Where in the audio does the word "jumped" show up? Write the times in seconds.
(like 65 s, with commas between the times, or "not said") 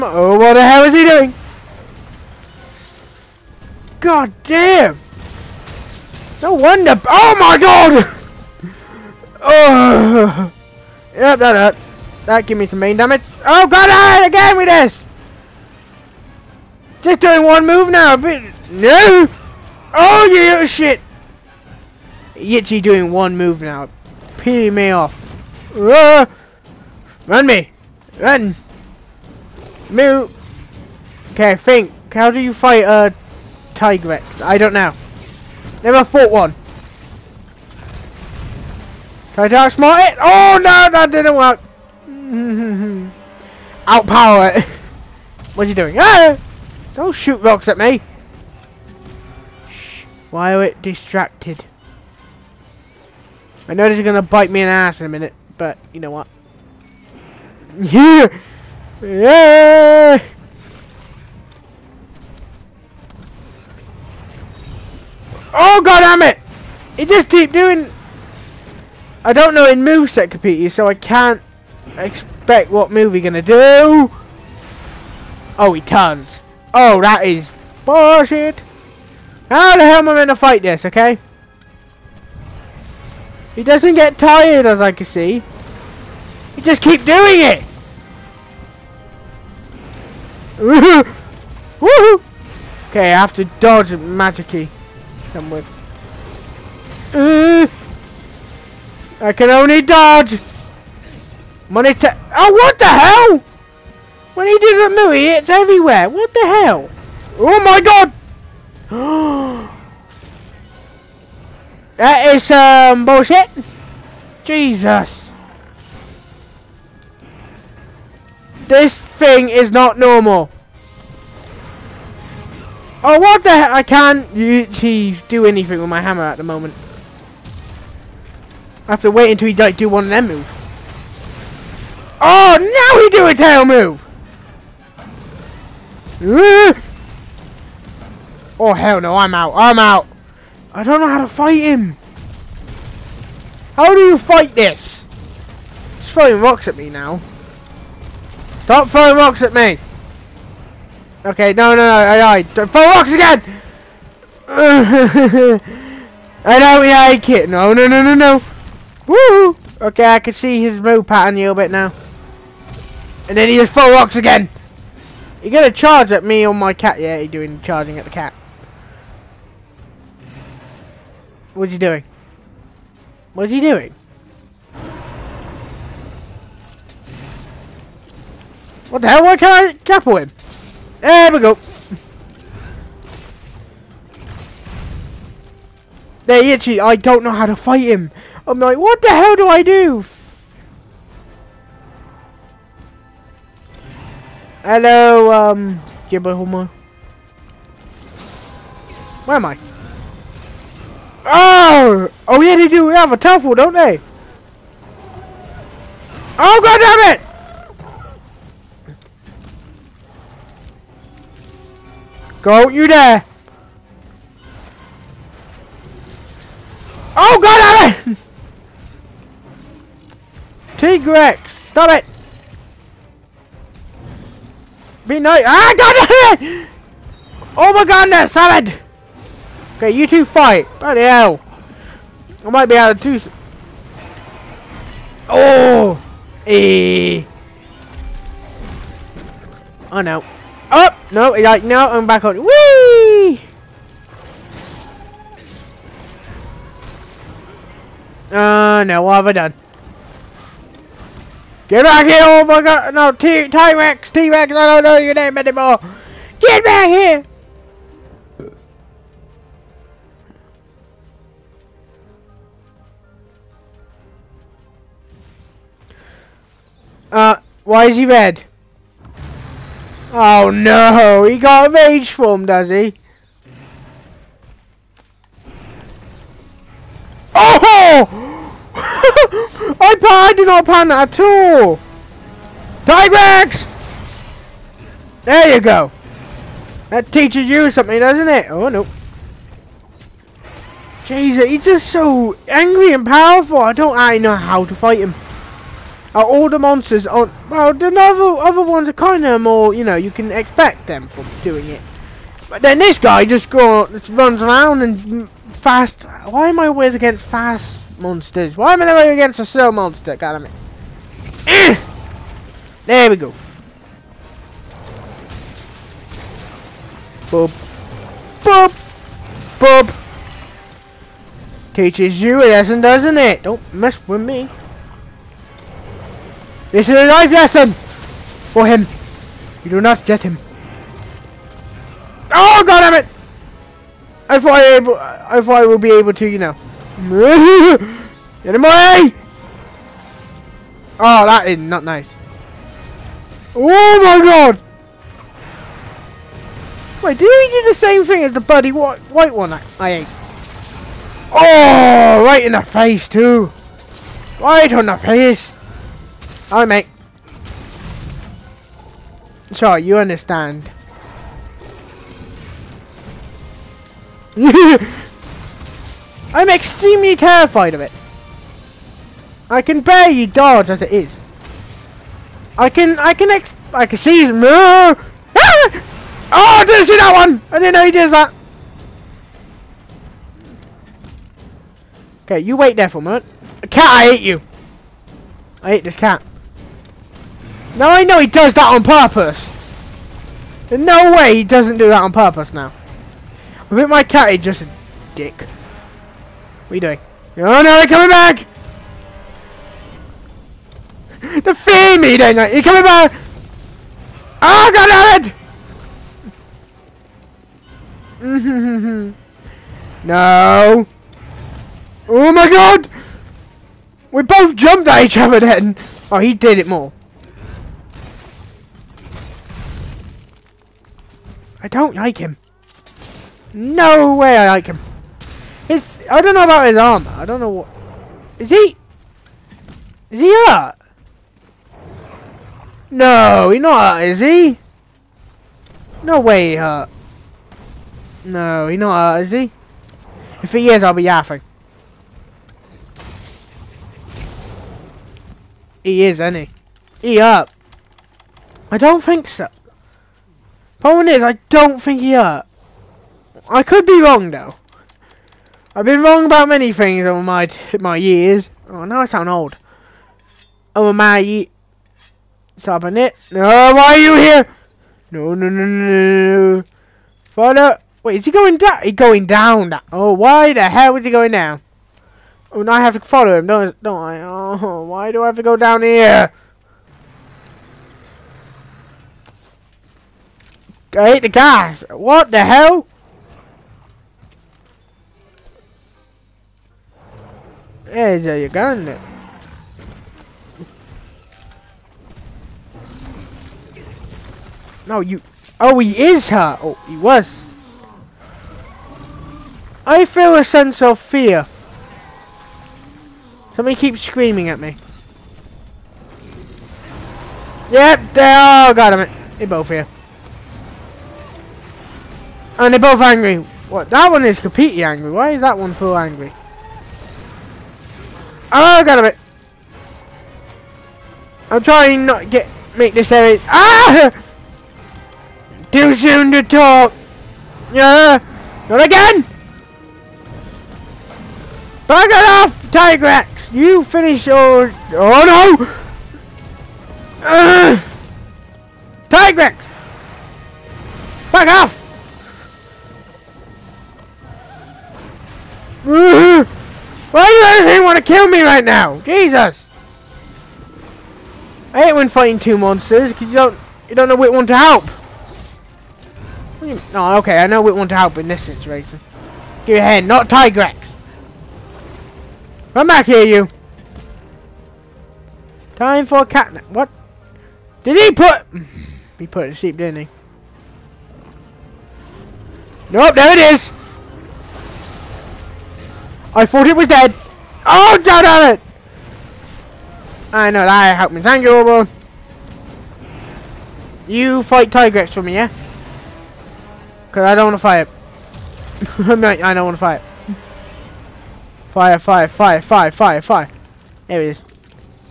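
414 s.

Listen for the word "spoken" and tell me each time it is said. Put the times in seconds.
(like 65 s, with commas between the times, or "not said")
not said.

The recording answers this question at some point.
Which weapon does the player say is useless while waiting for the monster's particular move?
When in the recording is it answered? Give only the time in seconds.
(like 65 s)
126 s.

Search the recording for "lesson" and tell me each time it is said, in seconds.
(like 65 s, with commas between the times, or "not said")
322 s, 327 s.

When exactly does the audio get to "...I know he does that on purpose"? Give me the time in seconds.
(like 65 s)
387 s.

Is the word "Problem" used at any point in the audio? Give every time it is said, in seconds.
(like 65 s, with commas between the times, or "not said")
450 s.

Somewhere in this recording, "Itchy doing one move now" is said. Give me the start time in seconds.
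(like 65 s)
22 s.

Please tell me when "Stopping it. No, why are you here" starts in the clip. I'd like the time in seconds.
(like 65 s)
462 s.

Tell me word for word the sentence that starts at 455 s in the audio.
I've been wrong about many things over my my years.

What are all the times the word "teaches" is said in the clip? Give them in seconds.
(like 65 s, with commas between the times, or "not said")
287 s, 321 s.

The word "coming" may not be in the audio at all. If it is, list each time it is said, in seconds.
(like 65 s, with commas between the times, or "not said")
397 s, 402 s.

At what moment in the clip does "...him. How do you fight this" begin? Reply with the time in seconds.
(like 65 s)
141 s.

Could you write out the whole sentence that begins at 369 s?
I can barely dodge as it is.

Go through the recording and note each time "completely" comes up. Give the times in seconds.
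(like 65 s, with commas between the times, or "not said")
514 s.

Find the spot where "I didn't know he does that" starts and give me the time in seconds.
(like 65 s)
377 s.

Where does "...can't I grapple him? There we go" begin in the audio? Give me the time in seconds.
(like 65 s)
179 s.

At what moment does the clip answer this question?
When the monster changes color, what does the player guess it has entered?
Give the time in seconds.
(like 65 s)
271 s.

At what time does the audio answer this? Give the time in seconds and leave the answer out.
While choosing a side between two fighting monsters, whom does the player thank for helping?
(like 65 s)
581 s.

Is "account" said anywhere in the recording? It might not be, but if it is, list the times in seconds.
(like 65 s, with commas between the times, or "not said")
not said.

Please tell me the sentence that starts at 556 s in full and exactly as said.
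No, oh, okay, I know which one to help in this situation.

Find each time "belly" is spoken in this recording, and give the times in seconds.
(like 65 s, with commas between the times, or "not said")
not said.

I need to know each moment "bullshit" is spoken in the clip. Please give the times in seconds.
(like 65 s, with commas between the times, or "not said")
77 s, 113 s.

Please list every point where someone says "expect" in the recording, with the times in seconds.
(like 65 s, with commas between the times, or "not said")
71 s, 300 s.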